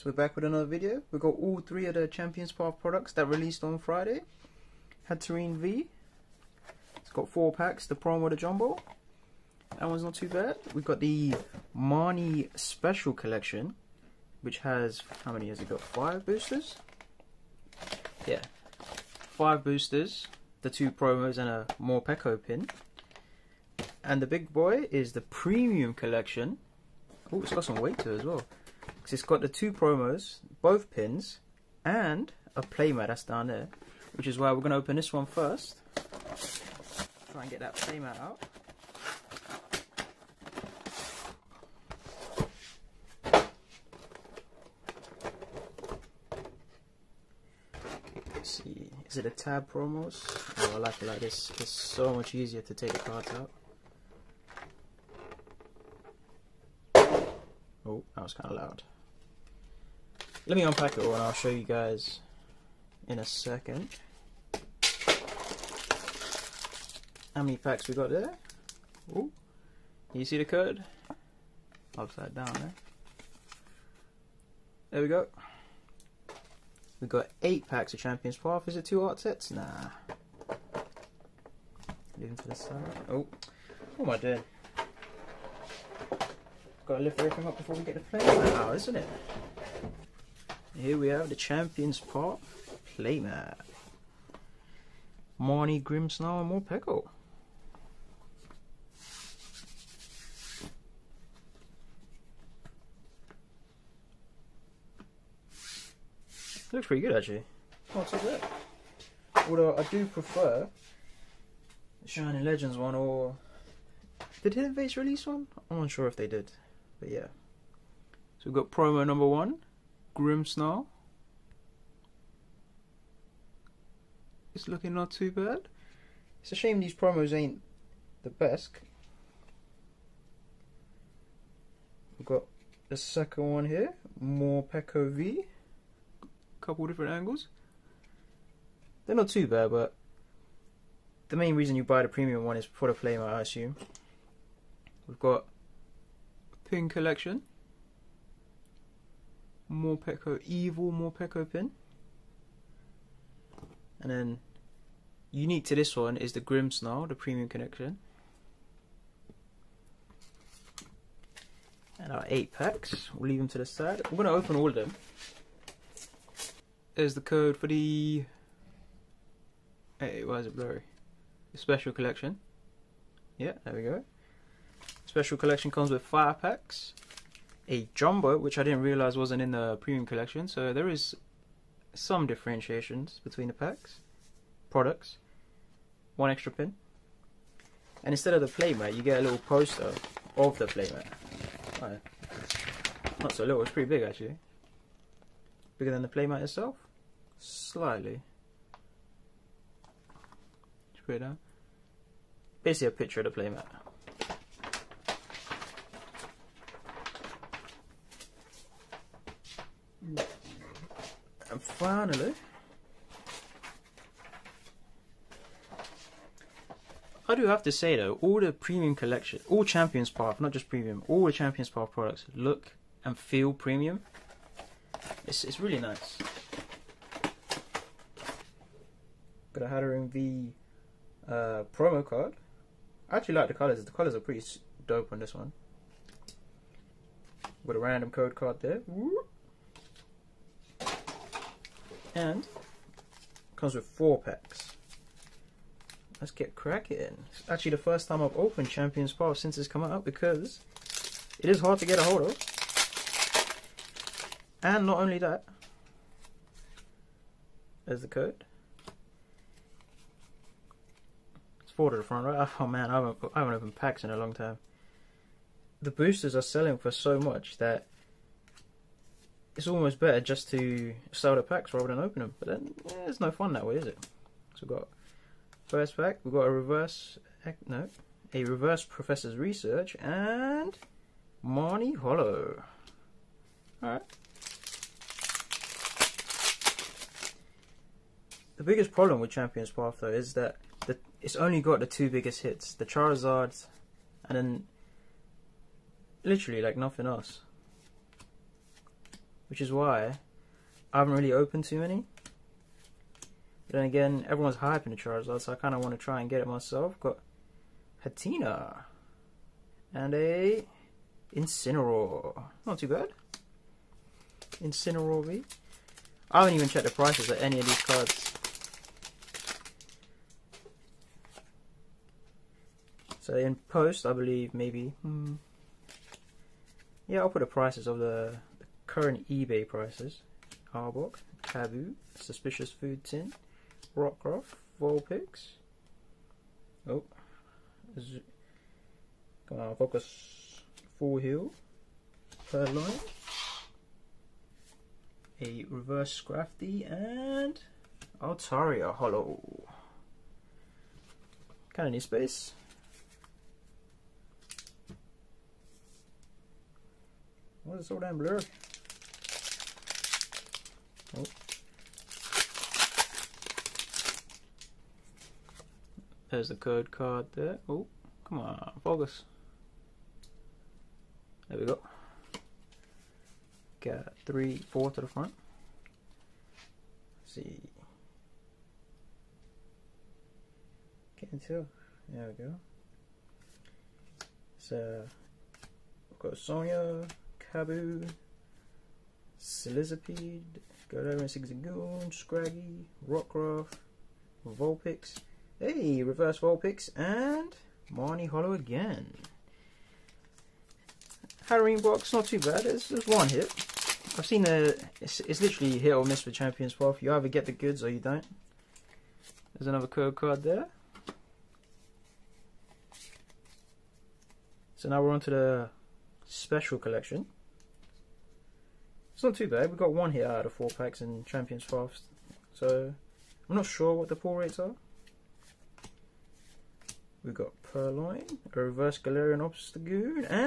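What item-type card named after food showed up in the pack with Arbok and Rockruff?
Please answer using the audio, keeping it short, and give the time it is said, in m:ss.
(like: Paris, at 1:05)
Suspicious Food Tin, at 5:32.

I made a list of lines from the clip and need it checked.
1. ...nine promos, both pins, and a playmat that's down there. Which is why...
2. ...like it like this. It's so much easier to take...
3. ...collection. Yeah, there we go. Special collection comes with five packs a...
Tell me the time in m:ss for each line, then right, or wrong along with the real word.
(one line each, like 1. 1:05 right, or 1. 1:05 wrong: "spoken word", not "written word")
1. 0:29 wrong: "two", not "nine"
2. 0:50 right
3. 2:51 right.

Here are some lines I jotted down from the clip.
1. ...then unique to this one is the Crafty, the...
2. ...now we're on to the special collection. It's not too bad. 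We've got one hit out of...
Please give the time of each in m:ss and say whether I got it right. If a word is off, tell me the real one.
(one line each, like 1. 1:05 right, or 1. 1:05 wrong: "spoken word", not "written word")
1. 2:34 wrong: "Grimmsnarl", not "Crafty"
2. 6:54 right.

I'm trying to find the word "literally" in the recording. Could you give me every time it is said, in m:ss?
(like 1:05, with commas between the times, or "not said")
4:56, 6:45.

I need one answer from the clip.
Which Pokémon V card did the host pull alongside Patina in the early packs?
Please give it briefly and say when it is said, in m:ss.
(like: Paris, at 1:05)
Incineroar V, at 5:14.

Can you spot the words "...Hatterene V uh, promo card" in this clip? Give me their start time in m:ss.
3:49.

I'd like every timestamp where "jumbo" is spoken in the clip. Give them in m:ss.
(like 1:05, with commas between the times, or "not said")
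0:08, 2:57.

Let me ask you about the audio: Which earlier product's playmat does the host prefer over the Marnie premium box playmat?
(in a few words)
Shining Legends.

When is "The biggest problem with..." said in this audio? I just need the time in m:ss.
4:48.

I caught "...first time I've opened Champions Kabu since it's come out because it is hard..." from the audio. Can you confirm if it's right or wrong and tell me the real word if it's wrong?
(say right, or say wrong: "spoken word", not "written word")
wrong: "Power", not "Kabu".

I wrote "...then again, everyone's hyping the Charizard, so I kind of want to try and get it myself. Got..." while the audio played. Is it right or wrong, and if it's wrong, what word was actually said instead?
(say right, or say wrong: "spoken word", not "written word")
right.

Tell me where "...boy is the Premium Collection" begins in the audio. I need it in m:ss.
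0:24.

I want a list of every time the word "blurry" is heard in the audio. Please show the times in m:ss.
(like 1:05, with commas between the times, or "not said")
2:50, 5:58.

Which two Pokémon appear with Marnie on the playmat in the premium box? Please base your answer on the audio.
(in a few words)
Grimmsnarl and Morpeko.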